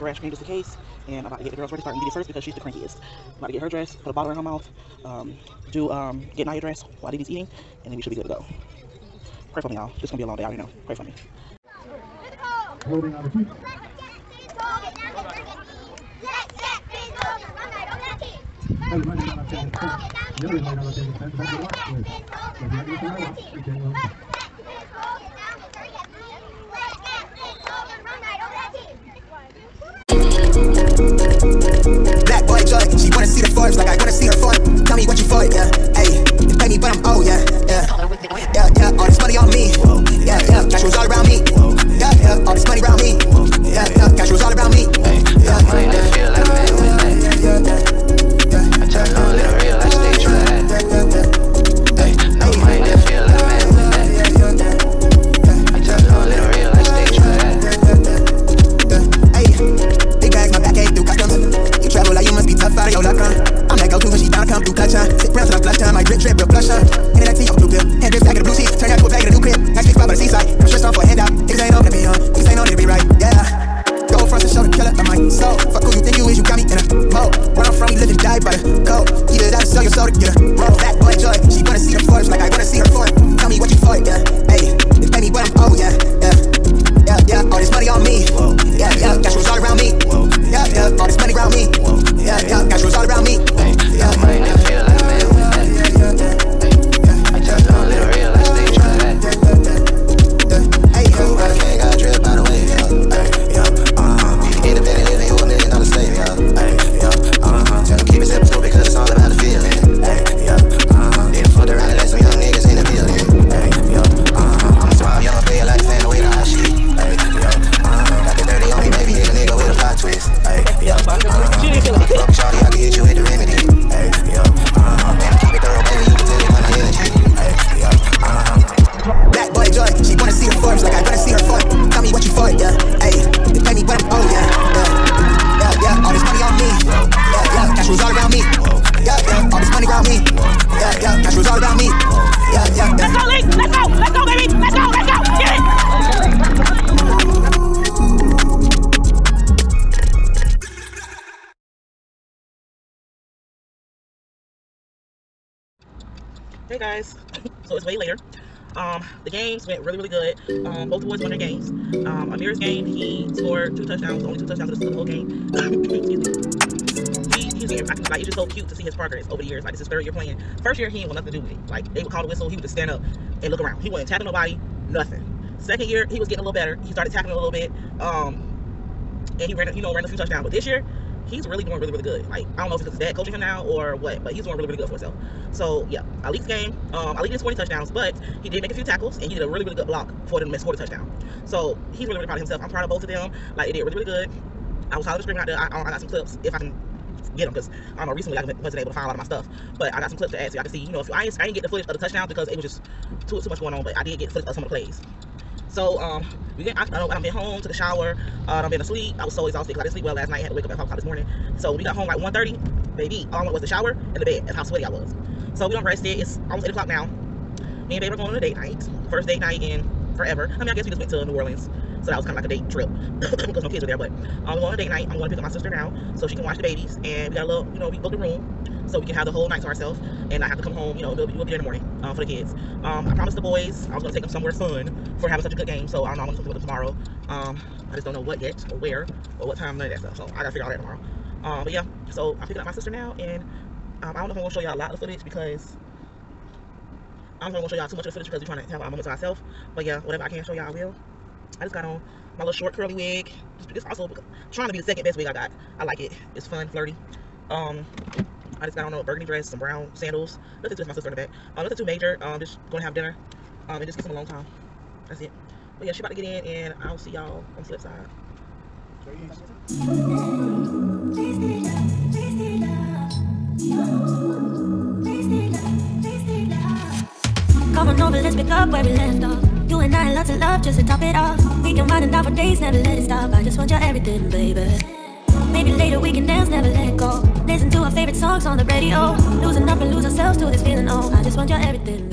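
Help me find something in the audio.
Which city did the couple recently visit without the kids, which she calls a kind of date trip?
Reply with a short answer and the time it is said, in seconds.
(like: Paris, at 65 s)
New Orleans, at 221 s.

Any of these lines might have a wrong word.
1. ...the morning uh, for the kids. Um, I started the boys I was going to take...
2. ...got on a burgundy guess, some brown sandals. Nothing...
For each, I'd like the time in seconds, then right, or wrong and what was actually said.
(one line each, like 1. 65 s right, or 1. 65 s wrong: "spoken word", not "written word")
1. 231 s wrong: "promised", not "started"
2. 258 s wrong: "dress", not "guess".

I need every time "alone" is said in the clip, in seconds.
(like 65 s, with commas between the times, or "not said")
264 s.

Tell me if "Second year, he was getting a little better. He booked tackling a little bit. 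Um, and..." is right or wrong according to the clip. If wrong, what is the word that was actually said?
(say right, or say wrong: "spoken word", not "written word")
wrong: "started", not "booked".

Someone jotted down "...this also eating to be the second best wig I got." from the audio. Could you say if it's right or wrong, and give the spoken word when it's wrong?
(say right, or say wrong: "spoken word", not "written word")
wrong: "trying", not "eating".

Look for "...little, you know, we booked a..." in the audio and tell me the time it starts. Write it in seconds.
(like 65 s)
227 s.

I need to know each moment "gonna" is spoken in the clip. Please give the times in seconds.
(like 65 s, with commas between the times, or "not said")
10 s, 262 s.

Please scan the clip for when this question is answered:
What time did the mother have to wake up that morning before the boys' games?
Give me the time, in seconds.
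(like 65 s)
210 s.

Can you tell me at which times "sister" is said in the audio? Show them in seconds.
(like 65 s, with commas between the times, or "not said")
225 s, 242 s, 260 s.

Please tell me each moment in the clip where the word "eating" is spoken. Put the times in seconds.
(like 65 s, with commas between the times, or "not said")
7 s.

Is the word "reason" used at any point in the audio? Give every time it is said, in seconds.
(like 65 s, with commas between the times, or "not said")
20 s.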